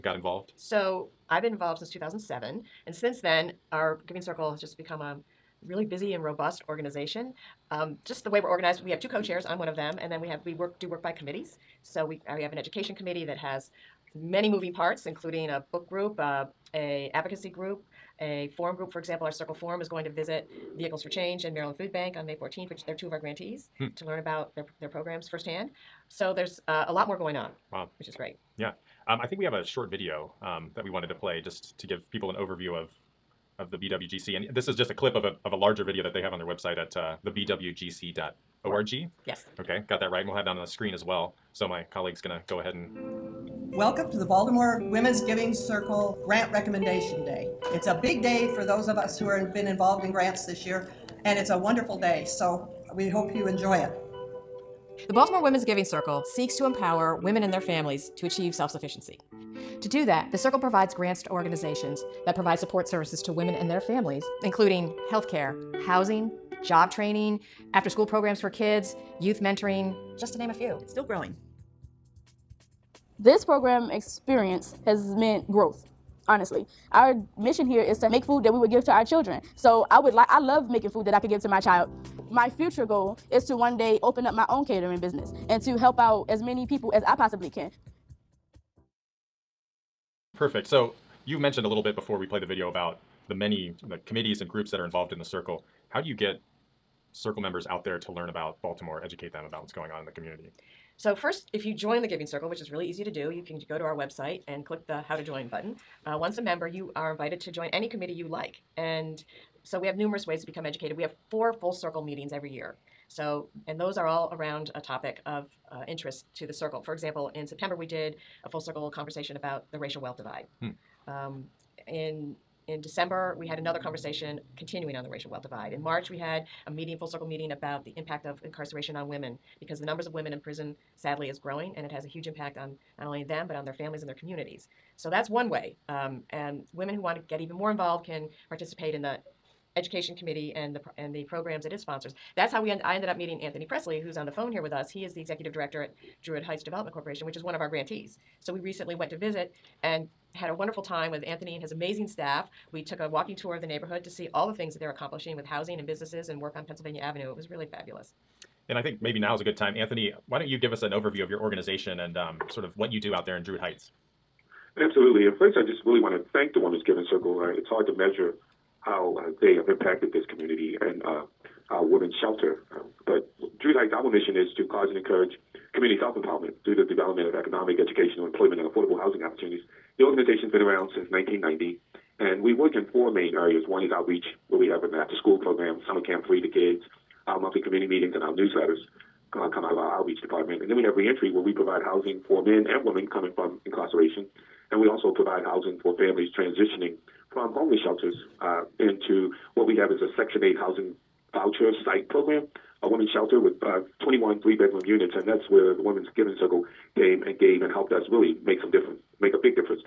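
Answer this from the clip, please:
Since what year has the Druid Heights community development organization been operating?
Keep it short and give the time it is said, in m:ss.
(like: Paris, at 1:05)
1990, at 3:01.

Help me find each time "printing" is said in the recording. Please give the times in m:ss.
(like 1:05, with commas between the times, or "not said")
not said.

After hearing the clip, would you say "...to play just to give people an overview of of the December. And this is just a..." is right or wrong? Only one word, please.
wrong.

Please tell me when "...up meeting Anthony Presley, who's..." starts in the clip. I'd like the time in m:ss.
2:23.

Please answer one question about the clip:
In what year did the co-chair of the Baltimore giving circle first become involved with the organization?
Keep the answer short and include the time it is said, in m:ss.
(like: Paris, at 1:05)
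2007, at 0:01.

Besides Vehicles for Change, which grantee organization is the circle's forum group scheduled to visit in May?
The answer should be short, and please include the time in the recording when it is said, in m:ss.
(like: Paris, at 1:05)
Maryland Food Bank, at 0:21.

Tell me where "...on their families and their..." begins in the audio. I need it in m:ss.
2:13.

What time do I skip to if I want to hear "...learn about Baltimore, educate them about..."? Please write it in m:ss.
1:38.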